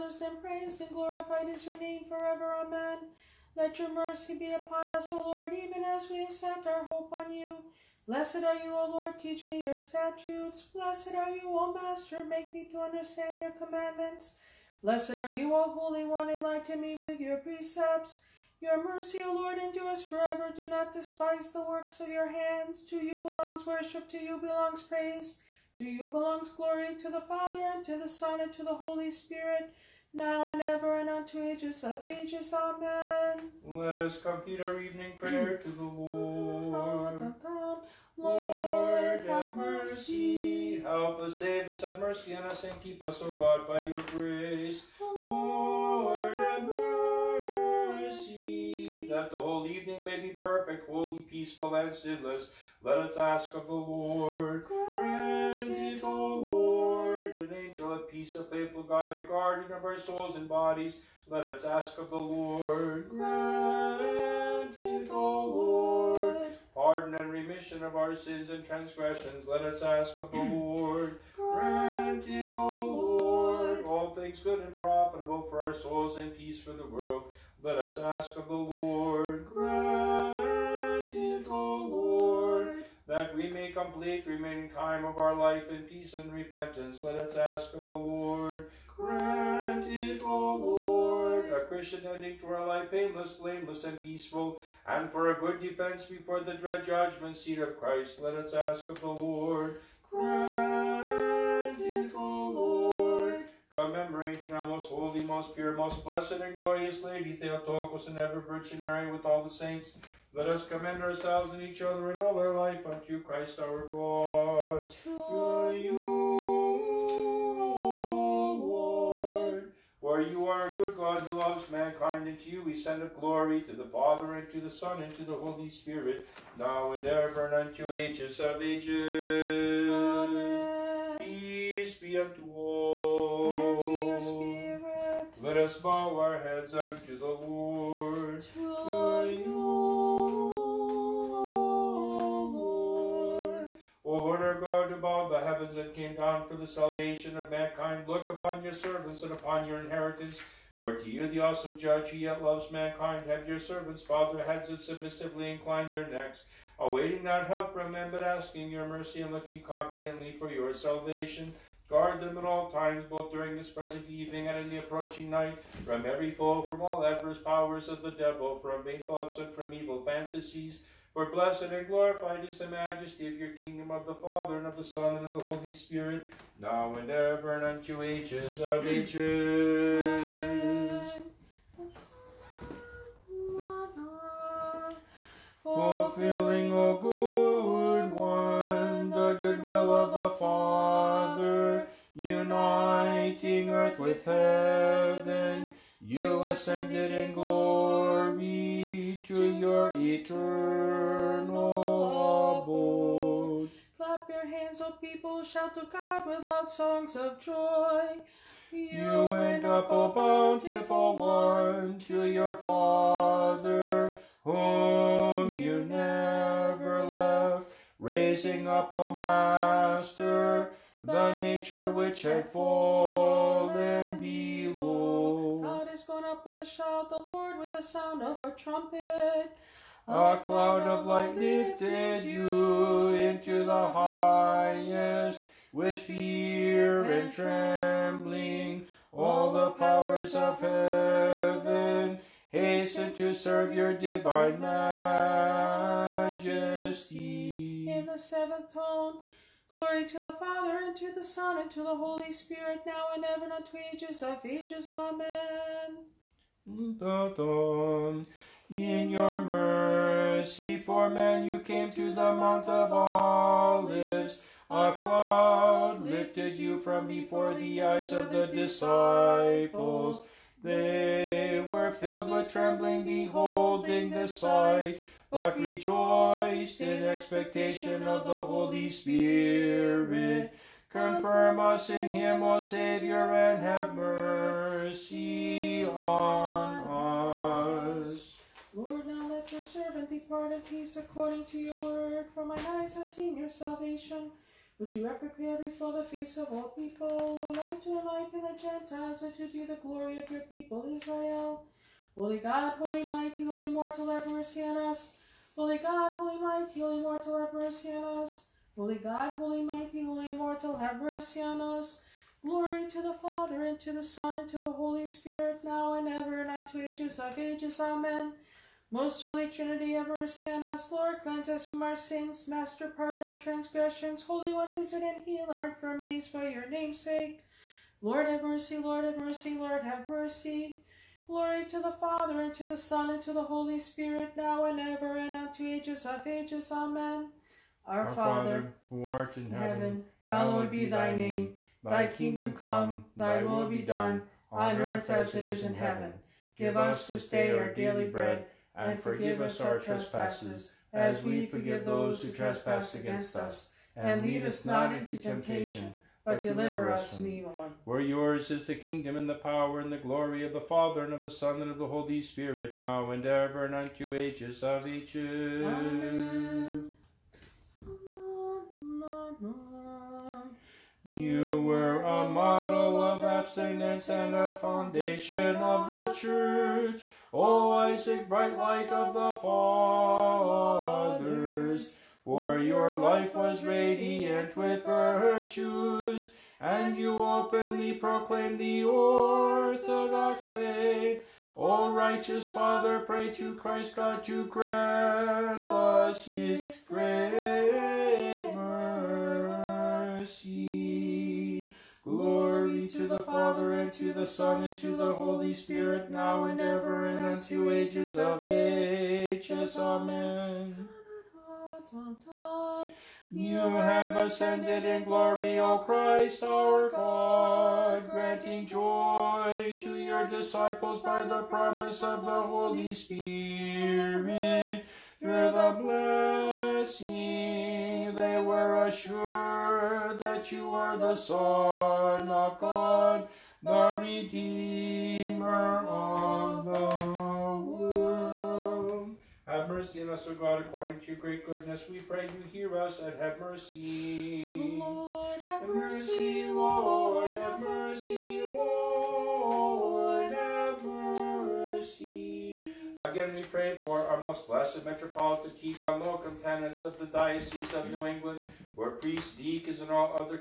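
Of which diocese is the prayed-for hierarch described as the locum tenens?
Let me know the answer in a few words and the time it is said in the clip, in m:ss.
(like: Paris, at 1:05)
New England, at 7:37.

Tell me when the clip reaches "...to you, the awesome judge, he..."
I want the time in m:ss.
2:30.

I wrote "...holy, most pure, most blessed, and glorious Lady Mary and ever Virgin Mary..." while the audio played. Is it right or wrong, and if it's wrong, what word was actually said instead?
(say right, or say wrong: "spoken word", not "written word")
wrong: "Theotokos", not "Mary".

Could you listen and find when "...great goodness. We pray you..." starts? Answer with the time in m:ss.
7:21.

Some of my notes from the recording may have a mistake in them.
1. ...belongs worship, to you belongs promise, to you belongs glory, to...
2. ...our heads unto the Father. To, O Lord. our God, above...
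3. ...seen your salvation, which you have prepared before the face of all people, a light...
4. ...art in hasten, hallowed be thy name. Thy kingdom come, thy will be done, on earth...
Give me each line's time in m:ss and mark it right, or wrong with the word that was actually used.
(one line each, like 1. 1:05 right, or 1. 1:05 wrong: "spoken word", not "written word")
1. 0:23 wrong: "praise", not "promise"
2. 2:16 wrong: "Lord", not "Father"
3. 4:53 right
4. 5:39 wrong: "heaven", not "hasten".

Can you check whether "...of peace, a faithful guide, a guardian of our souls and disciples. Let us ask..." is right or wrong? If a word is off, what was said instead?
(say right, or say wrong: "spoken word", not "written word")
wrong: "bodies", not "disciples".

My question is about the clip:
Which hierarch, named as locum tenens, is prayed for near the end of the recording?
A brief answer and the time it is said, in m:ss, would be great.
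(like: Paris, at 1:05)
Metropolitan Tikhon, at 7:34.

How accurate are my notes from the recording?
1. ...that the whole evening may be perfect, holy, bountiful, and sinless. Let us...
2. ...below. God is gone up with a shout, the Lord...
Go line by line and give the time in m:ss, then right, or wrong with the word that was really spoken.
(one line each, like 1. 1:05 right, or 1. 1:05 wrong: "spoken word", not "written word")
1. 0:49 wrong: "peaceful", not "bountiful"
2. 3:44 right.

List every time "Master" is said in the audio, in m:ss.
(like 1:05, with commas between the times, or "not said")
0:11, 3:39, 5:22.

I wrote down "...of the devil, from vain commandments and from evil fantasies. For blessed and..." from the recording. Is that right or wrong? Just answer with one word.
wrong.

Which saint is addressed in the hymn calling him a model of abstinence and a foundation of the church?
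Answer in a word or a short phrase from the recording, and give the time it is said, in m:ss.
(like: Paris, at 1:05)
Isaac, at 6:17.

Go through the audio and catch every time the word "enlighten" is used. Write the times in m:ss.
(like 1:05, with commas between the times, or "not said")
0:16, 4:57.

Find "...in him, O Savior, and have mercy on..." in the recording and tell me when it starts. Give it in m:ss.
4:41.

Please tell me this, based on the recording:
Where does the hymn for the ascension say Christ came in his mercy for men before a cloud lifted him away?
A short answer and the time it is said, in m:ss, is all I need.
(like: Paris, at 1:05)
Mount of Olives, at 4:22.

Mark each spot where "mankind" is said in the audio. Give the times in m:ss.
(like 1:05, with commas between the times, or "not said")
2:01, 2:27, 2:32.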